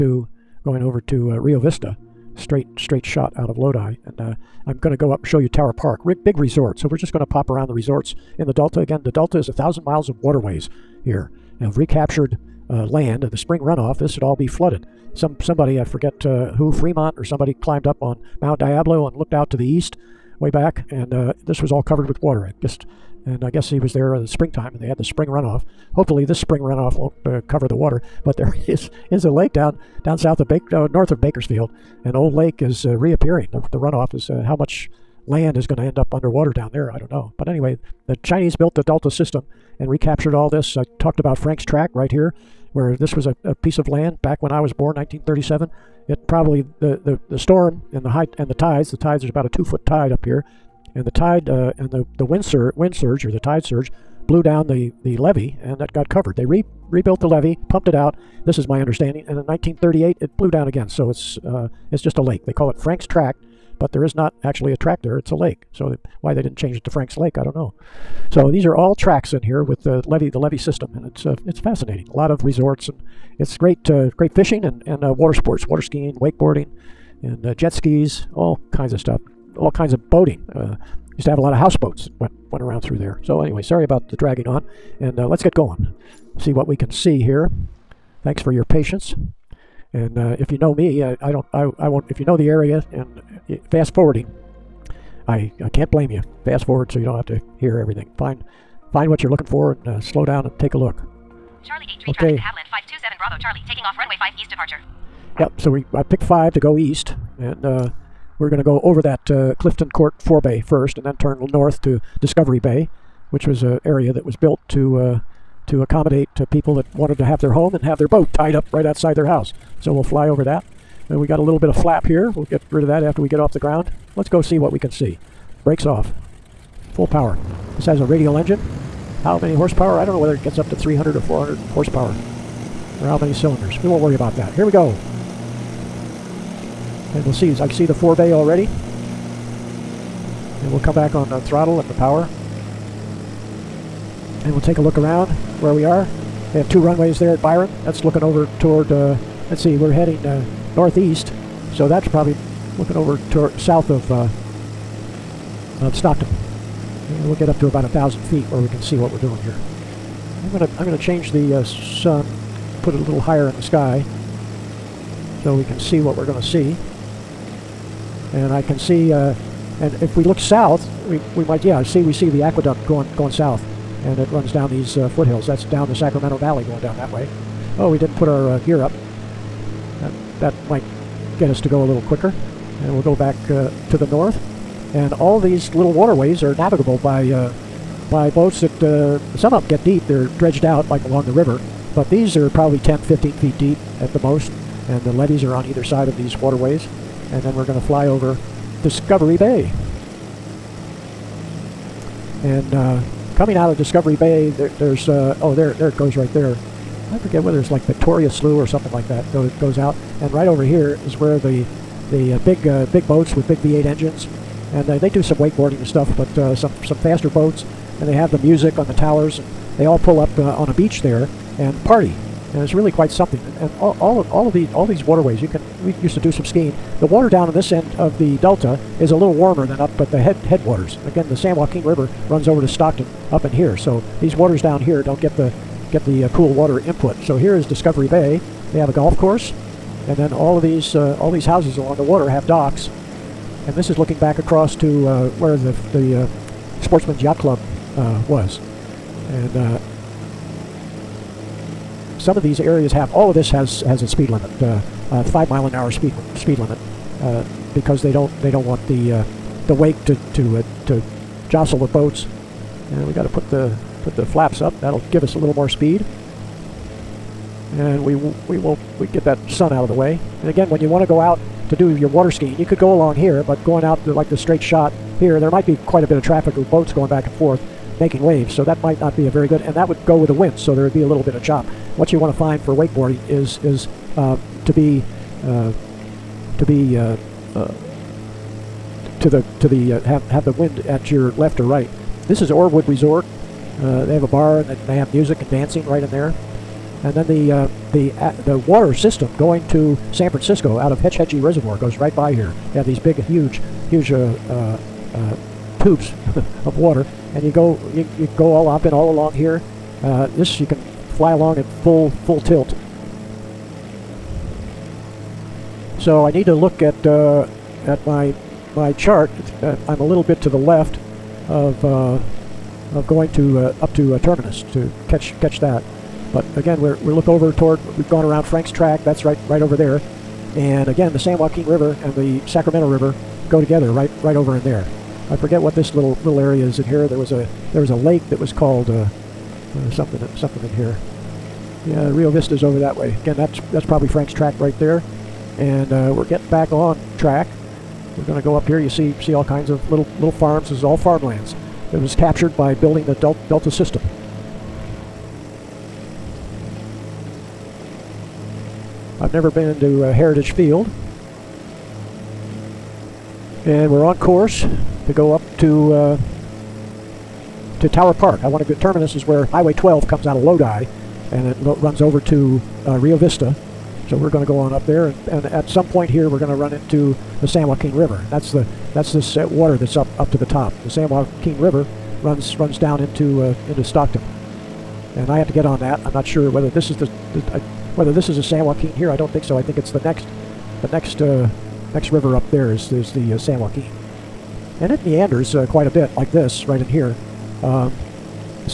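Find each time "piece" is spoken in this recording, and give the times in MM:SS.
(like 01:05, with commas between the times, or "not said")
00:43.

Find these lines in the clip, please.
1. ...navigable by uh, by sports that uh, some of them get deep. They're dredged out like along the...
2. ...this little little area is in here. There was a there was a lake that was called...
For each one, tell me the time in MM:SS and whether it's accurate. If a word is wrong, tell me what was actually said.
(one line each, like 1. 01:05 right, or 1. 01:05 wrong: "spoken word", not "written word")
1. 03:06 wrong: "boats", not "sports"
2. 05:35 right.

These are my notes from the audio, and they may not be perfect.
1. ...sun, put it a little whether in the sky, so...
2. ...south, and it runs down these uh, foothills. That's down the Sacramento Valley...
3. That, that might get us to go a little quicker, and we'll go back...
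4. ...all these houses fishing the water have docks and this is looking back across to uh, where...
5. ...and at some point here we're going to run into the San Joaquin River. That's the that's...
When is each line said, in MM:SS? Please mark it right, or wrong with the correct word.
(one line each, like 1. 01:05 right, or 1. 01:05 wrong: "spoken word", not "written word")
1. 02:41 wrong: "higher", not "whether"
2. 02:53 right
3. 03:00 right
4. 04:01 wrong: "along", not "fishing"
5. 06:15 right.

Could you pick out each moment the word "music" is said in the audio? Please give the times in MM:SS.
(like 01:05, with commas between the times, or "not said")
03:38, 04:55.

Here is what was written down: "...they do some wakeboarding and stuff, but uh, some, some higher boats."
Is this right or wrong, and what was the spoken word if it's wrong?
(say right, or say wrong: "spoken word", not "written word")
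wrong: "faster", not "higher".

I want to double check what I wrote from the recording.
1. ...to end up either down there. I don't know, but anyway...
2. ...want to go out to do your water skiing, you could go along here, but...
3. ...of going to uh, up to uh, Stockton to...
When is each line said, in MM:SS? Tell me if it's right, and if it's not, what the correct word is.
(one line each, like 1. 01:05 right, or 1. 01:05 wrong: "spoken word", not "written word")
1. 00:35 wrong: "underwater", not "either"
2. 04:30 right
3. 05:22 wrong: "Terminous", not "Stockton".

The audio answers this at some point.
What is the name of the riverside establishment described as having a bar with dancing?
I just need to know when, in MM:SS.
04:52.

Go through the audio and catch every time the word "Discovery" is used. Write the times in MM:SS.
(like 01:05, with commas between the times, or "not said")
01:52, 03:18, 03:23, 03:57.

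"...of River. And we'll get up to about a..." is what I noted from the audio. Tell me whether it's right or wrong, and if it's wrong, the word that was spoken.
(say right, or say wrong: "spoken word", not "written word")
wrong: "Stockton", not "River".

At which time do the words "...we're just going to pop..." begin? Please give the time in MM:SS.
00:06.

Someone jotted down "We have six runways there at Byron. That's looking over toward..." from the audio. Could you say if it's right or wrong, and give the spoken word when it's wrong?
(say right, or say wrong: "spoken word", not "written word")
wrong: "two", not "six".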